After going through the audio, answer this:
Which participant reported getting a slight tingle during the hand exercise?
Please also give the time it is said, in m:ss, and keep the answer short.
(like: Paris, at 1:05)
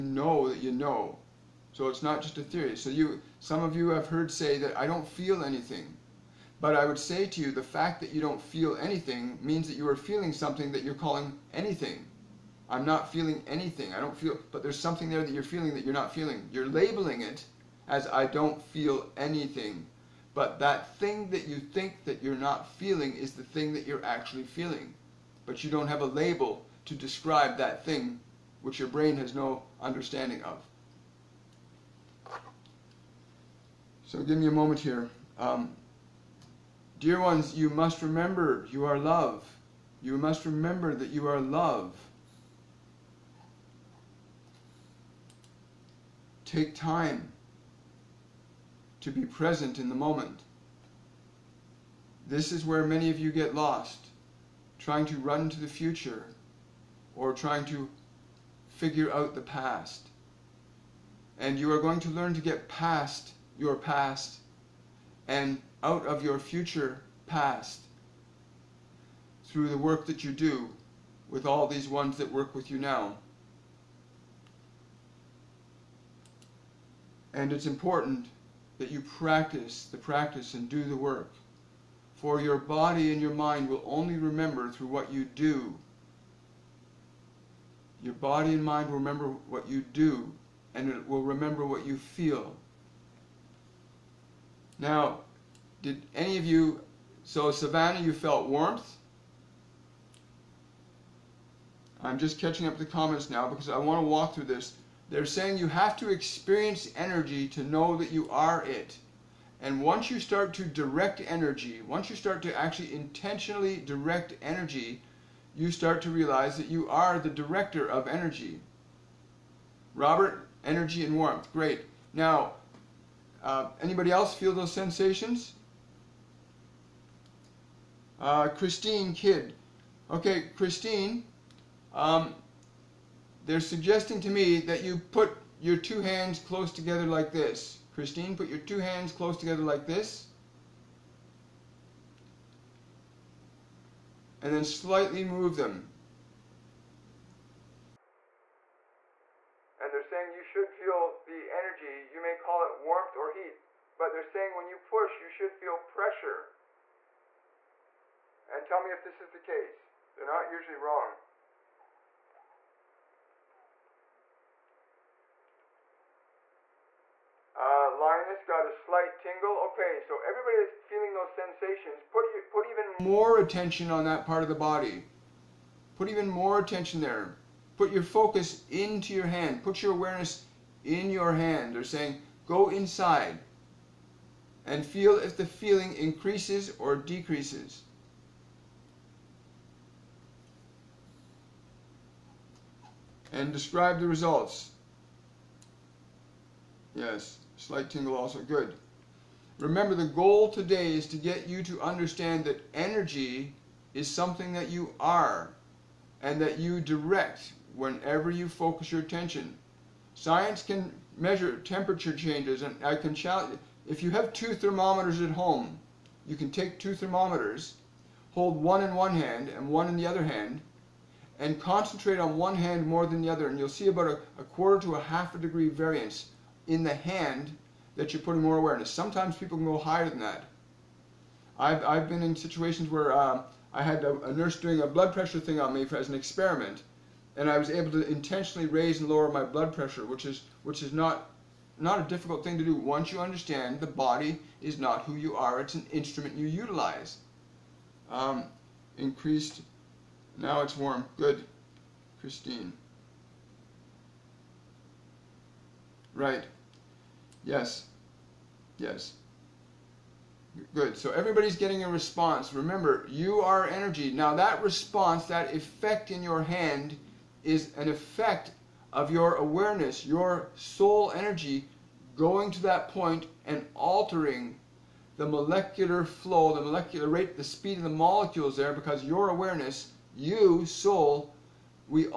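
Linus, at 2:47.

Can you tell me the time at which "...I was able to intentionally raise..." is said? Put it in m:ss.
3:57.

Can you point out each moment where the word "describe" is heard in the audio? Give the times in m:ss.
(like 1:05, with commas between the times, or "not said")
0:26, 3:13.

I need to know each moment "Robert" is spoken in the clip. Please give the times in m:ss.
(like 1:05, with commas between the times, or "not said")
1:59.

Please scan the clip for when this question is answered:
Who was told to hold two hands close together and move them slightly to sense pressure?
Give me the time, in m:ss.
2:08.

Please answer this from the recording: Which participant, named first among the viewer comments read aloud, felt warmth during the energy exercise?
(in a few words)
Savannah.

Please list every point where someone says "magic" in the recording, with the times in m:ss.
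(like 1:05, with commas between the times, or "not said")
not said.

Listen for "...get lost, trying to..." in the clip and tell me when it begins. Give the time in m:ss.
0:53.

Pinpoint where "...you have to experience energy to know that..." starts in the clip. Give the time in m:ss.
1:45.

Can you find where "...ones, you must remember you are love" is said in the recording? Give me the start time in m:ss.
0:37.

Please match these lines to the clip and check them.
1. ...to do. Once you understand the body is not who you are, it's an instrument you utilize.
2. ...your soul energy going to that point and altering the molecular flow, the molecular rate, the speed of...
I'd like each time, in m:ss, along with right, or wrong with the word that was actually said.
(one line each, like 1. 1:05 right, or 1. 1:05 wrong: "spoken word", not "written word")
1. 4:02 right
2. 4:30 right.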